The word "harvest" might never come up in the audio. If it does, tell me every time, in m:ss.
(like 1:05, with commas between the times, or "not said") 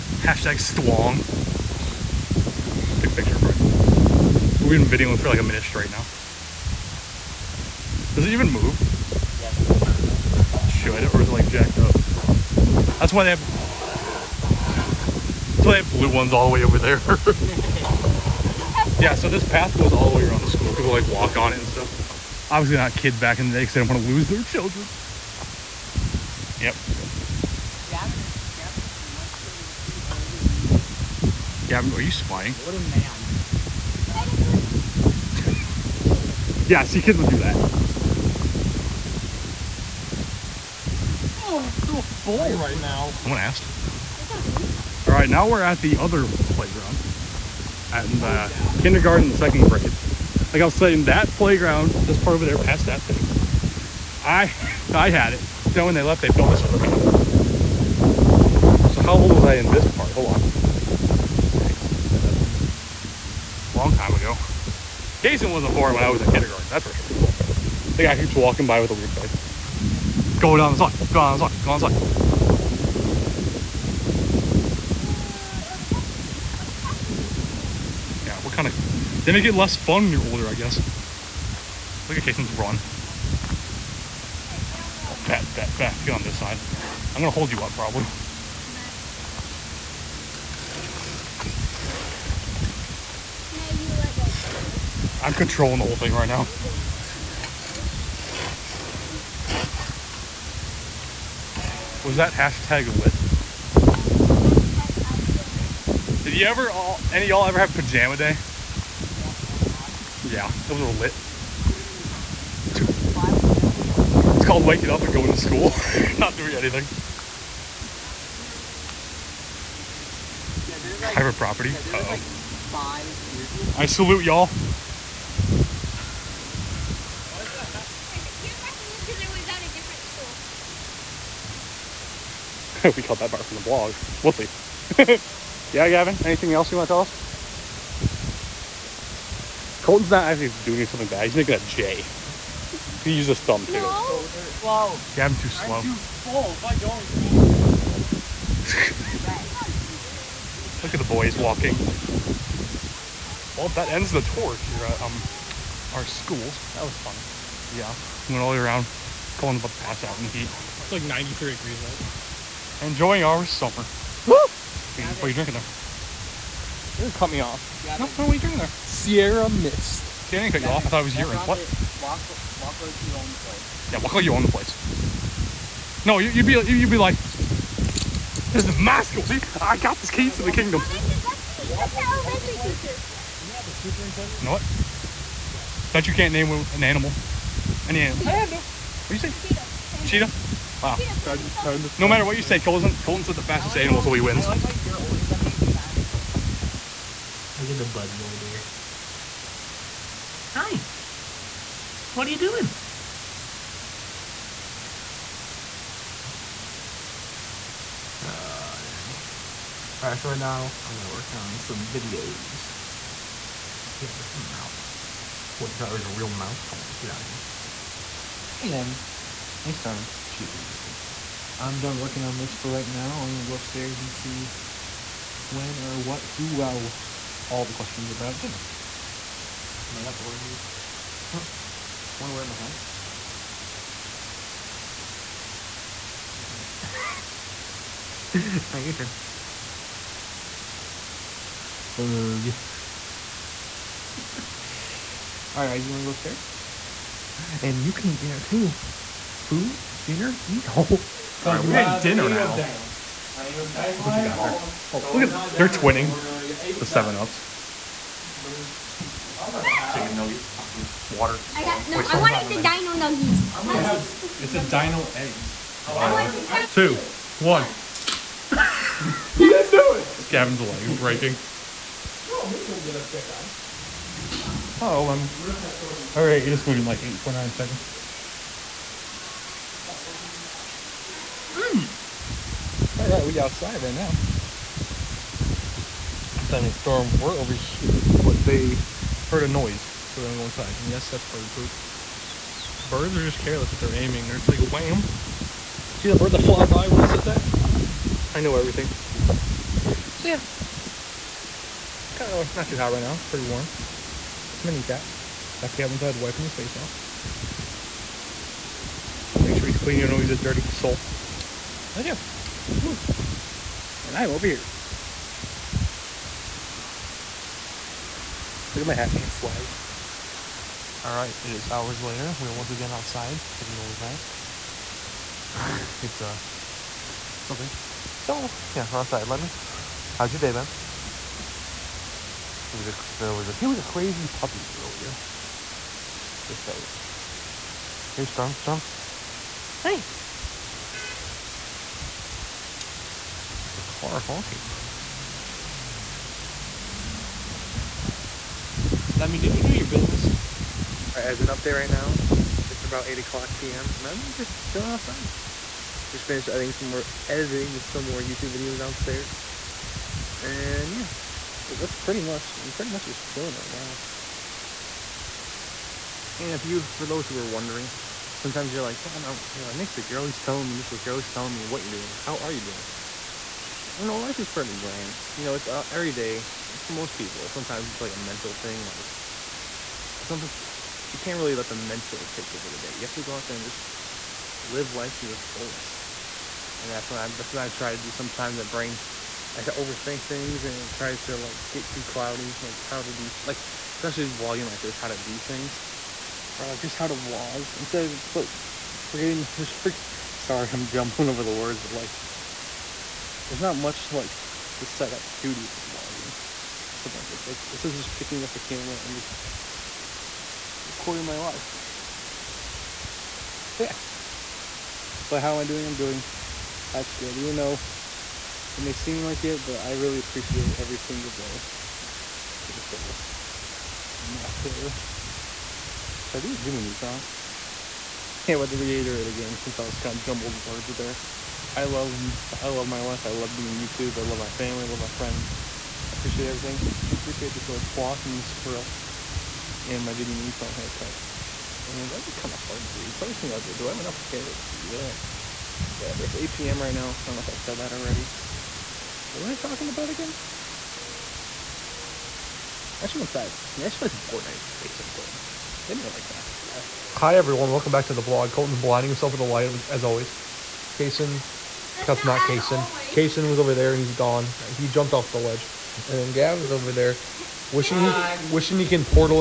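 not said.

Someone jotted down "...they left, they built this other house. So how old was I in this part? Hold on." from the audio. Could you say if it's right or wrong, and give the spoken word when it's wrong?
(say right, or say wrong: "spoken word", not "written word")
right.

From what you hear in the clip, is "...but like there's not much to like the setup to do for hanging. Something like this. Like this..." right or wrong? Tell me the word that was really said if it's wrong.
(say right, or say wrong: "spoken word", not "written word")
wrong: "vlogging", not "hanging".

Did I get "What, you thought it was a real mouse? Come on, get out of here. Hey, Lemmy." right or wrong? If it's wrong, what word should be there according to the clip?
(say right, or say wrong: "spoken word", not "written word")
right.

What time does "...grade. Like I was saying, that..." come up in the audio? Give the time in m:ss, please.
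0:49.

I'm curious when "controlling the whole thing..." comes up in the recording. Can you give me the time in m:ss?
1:35.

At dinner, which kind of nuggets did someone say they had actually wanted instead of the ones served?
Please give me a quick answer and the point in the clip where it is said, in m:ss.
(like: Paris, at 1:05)
dino nuggets, at 4:22.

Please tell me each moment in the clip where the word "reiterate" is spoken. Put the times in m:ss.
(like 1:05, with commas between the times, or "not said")
7:08.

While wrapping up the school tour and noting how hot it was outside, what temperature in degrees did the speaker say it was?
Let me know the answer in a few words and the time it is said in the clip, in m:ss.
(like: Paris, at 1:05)
93, at 2:41.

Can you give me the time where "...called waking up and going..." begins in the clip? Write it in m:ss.
1:54.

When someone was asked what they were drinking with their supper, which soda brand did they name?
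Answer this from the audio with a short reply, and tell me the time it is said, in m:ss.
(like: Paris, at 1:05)
Sierra Mist, at 2:48.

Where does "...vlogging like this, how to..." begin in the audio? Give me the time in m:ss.
6:34.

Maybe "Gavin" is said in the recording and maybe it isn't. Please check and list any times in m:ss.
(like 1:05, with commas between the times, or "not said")
0:31, 2:15, 2:25, 5:05, 7:46.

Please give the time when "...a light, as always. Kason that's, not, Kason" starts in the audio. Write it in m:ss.
7:39.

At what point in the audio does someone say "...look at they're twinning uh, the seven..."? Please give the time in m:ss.
4:14.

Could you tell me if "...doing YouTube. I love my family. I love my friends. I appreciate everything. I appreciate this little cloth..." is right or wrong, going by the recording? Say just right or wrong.
right.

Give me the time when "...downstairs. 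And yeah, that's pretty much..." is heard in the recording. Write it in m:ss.
5:58.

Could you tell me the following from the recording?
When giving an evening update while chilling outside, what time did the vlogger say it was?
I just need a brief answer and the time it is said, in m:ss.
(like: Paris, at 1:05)
8 p.m., at 5:53.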